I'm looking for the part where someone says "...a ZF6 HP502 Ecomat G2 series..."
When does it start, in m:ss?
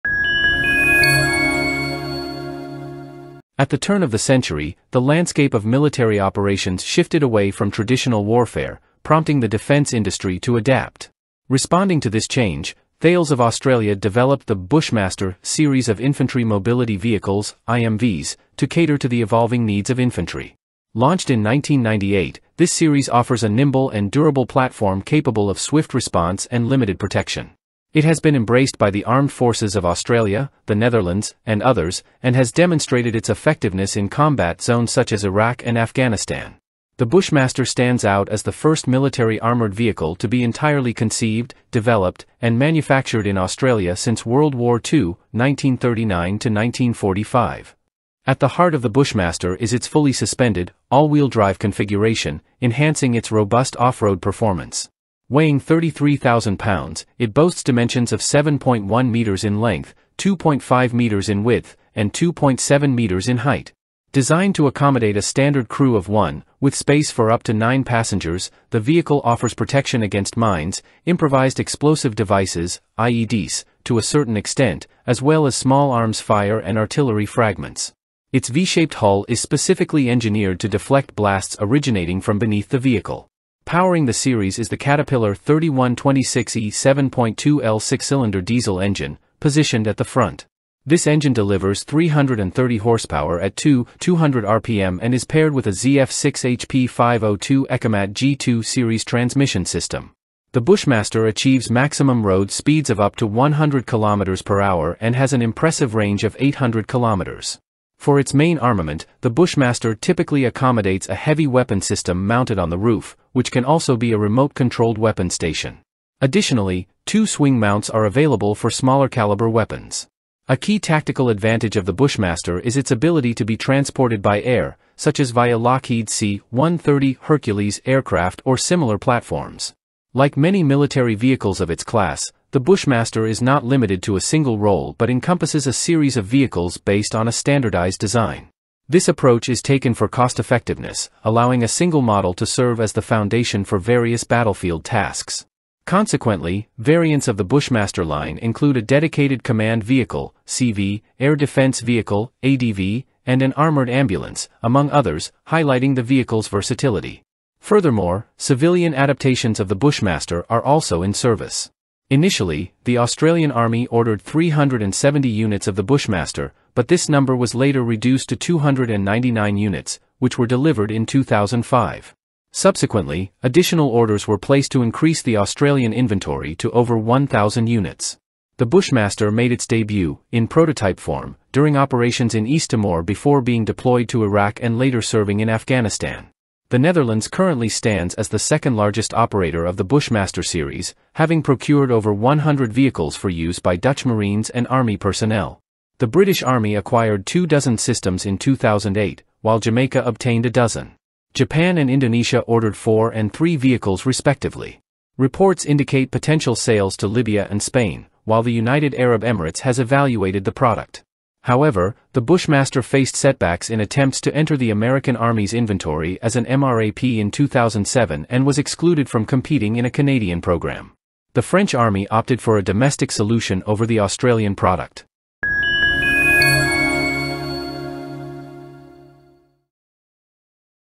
1:35.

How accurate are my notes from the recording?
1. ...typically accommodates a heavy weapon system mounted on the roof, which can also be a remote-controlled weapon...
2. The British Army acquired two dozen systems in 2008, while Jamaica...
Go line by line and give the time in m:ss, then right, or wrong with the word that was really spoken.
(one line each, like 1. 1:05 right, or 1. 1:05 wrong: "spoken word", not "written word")
1. 1:49 right
2. 3:15 right.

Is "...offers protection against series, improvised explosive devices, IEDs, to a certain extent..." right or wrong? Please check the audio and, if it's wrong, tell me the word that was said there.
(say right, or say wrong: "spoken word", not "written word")
wrong: "mines", not "series".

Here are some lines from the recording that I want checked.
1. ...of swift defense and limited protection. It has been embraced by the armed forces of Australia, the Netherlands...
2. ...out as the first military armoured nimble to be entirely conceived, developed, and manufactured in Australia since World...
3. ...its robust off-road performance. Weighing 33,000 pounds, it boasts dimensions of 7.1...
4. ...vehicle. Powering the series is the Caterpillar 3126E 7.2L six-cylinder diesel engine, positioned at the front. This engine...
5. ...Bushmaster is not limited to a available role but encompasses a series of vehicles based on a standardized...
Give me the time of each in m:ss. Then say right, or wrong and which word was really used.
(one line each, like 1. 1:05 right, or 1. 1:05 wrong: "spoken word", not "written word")
1. 0:25 wrong: "response", not "defense"
2. 0:38 wrong: "vehicle", not "nimble"
3. 0:53 right
4. 1:22 right
5. 2:12 wrong: "single", not "available".